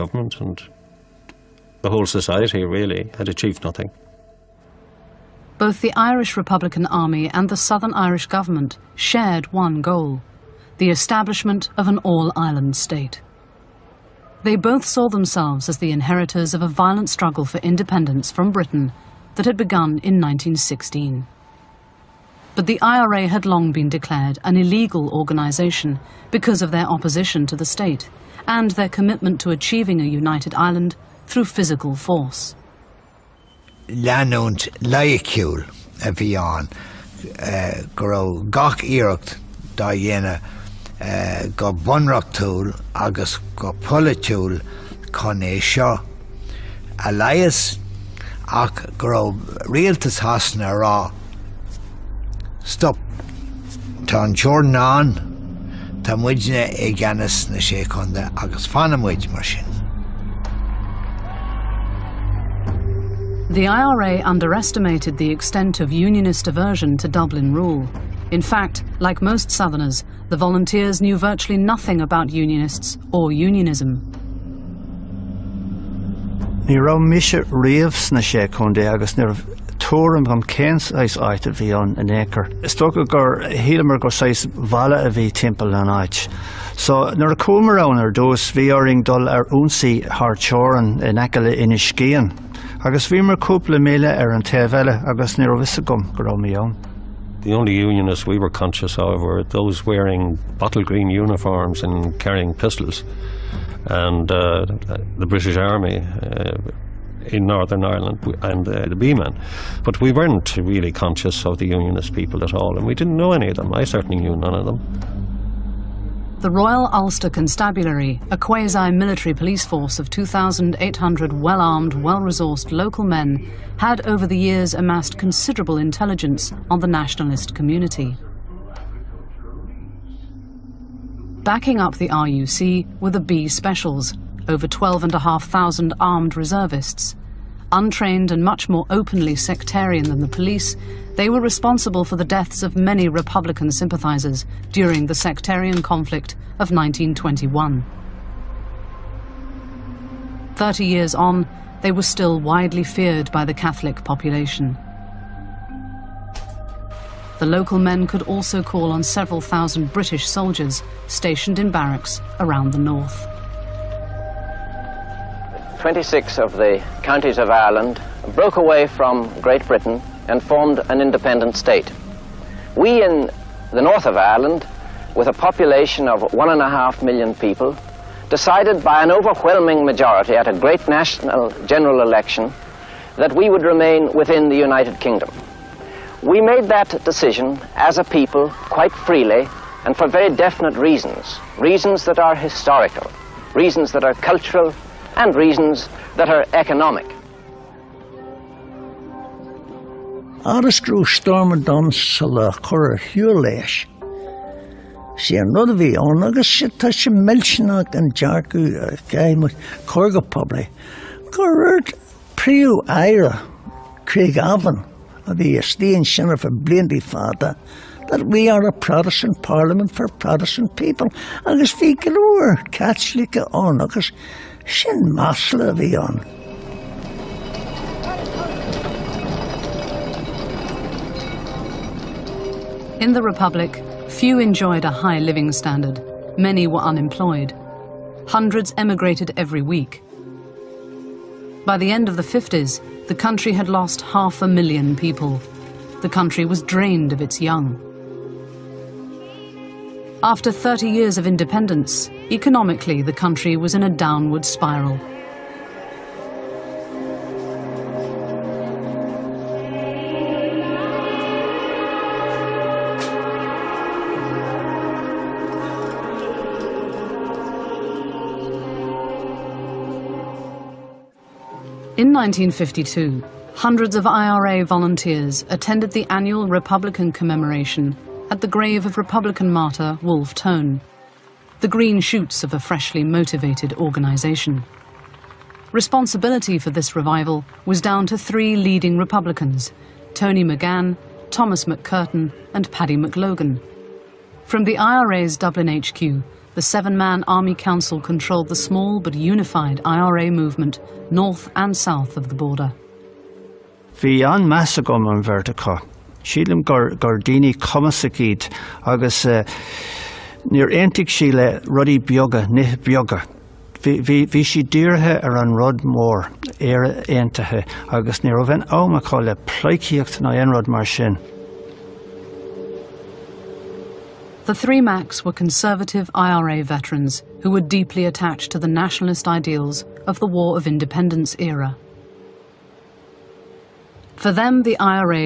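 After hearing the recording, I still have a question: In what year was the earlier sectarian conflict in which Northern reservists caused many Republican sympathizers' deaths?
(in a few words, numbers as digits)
1921.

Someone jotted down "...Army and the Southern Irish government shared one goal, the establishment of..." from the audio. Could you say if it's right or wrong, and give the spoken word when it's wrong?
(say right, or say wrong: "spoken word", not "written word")
right.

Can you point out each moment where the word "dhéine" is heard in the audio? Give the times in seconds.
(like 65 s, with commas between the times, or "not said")
39 s.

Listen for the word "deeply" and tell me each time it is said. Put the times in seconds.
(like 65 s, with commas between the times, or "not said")
327 s.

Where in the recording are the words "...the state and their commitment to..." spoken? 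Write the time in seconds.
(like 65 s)
27 s.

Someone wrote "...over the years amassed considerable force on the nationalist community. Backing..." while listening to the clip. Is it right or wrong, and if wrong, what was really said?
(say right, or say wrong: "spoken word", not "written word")
wrong: "intelligence", not "force".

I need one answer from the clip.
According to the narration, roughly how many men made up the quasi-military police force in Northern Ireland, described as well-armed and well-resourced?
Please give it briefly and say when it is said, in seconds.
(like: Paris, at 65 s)
2,800, at 120 s.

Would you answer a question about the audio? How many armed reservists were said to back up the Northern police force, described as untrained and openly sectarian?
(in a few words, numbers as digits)
12,500.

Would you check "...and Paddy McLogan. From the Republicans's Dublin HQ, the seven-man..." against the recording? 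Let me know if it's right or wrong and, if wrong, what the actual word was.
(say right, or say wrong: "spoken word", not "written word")
wrong: "IRA", not "Republicans".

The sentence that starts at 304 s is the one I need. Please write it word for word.
Bhí an measa vertica, an gardini sílim agus eh, Near antic sí le rudí beaga ní beaga.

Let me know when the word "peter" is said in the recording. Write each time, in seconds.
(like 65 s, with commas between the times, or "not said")
not said.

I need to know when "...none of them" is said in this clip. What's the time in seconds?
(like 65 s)
114 s.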